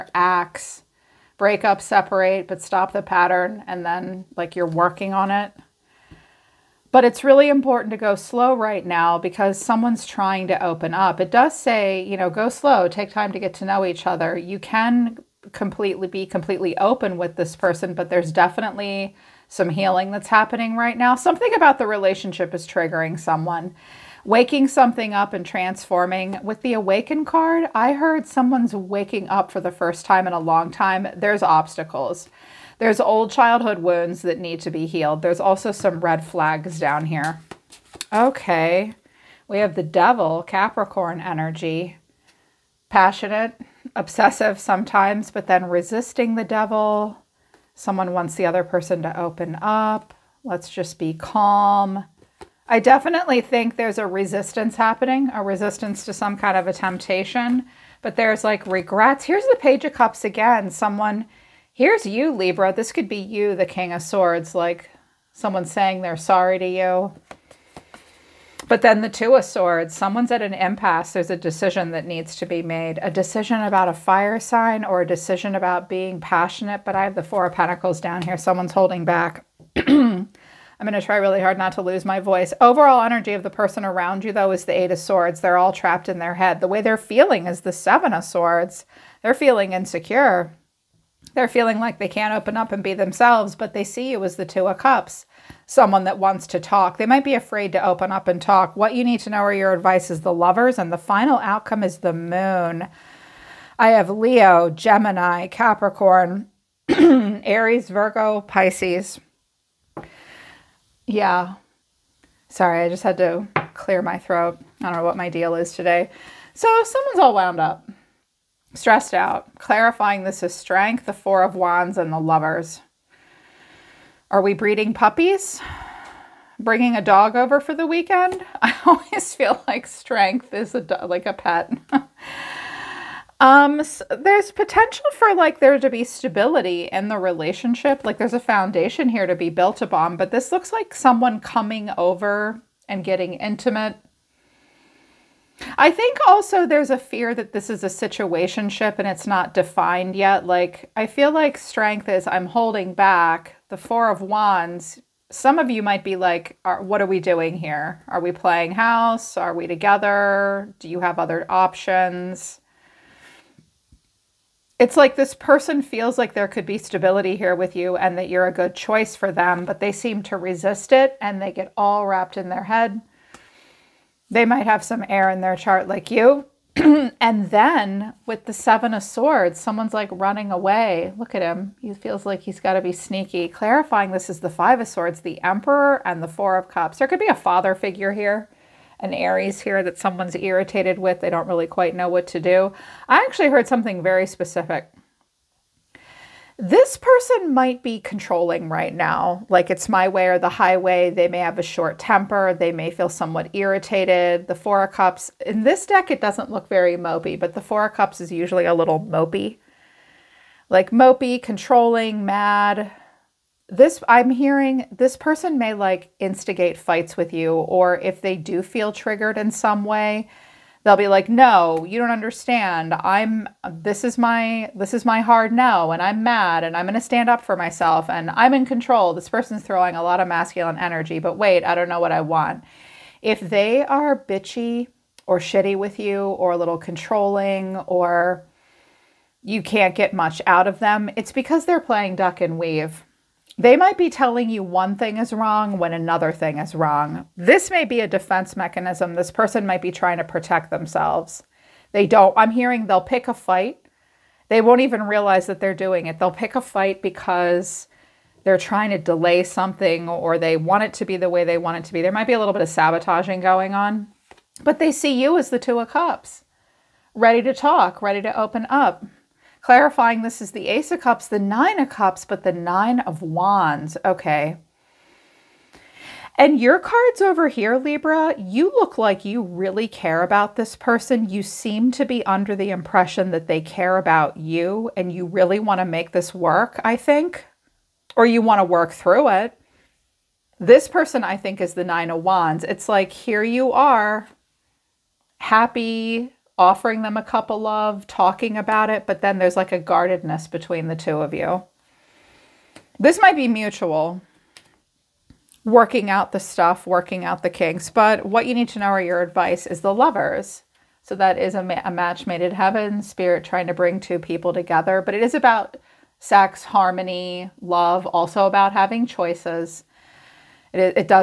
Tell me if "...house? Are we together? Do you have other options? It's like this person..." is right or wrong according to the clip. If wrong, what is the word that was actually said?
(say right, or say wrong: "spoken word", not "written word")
right.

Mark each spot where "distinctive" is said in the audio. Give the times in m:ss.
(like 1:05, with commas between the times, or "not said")
not said.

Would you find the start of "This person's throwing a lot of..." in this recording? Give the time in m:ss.
3:49.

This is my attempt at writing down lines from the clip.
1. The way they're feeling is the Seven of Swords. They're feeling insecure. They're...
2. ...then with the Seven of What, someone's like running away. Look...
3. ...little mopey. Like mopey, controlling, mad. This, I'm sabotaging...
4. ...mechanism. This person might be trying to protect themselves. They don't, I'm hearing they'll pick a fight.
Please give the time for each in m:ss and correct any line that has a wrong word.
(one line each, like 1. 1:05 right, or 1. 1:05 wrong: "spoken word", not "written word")
1. 1:26 right
2. 2:57 wrong: "Swords", not "What"
3. 3:28 wrong: "hearing", not "sabotaging"
4. 4:08 right.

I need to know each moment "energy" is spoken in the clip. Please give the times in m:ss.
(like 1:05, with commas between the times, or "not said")
0:41, 1:23, 3:50.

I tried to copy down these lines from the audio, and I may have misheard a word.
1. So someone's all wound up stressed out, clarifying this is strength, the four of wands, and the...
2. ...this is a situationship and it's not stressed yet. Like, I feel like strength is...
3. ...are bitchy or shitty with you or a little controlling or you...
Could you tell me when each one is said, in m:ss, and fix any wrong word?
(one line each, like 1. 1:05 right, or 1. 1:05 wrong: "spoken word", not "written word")
1. 1:56 right
2. 2:27 wrong: "defined", not "stressed"
3. 3:53 right.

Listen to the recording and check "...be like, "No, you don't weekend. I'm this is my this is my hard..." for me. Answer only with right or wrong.
wrong.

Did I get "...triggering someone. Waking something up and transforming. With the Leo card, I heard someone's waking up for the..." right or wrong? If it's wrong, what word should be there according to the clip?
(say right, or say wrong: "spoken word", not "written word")
wrong: "Awaken", not "Leo".